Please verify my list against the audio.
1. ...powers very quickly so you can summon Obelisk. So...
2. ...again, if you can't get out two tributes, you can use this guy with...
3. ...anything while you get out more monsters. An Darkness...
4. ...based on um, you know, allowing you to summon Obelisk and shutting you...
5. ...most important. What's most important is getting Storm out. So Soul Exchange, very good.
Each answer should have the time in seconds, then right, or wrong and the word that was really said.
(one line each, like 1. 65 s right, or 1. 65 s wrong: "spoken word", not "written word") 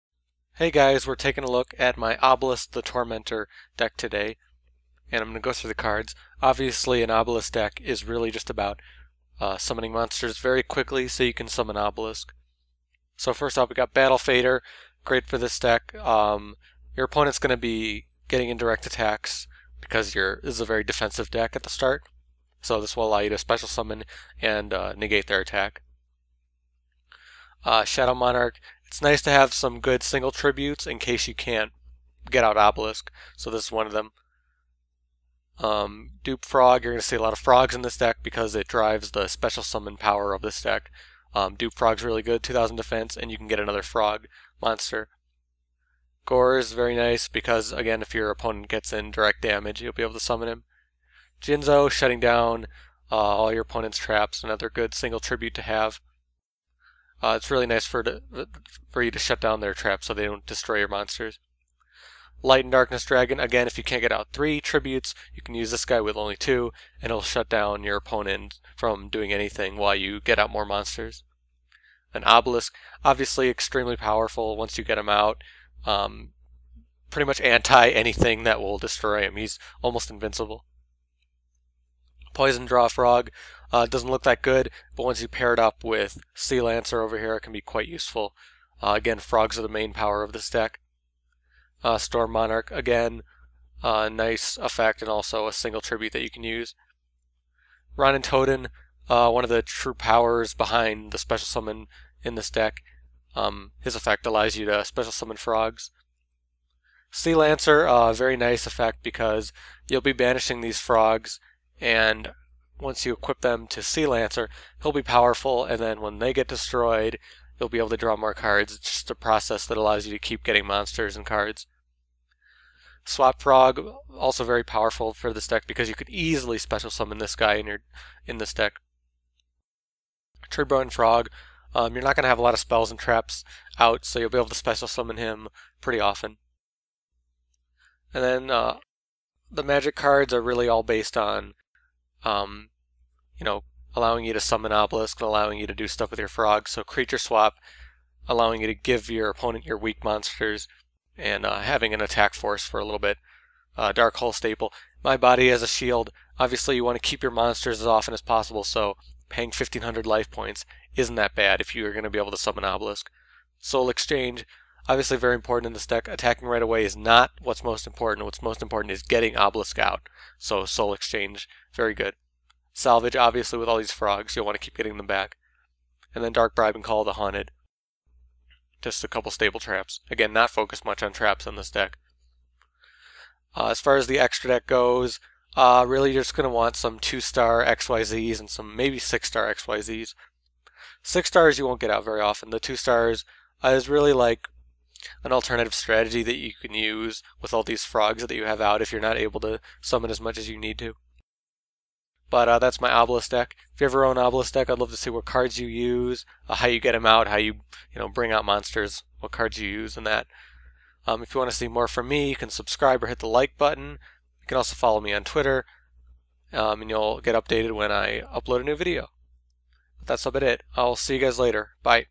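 1. 9 s wrong: "monsters", not "powers"
2. 63 s wrong: "three", not "two"
3. 69 s wrong: "Obelisk", not "Darkness"
4. 140 s wrong: "allowing", not "shutting"
5. 167 s wrong: "Obelisk", not "Storm".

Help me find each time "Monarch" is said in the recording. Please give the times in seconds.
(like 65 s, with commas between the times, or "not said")
28 s, 92 s.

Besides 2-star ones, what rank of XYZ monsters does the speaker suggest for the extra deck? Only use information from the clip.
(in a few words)
6-star.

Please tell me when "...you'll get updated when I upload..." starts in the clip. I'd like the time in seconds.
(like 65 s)
216 s.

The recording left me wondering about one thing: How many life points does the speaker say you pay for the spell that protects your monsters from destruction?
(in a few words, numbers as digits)
1500.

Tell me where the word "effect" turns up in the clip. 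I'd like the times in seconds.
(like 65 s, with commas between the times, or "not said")
94 s, 103 s, 108 s.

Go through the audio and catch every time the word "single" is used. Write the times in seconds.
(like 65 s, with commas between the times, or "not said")
30 s, 54 s, 95 s.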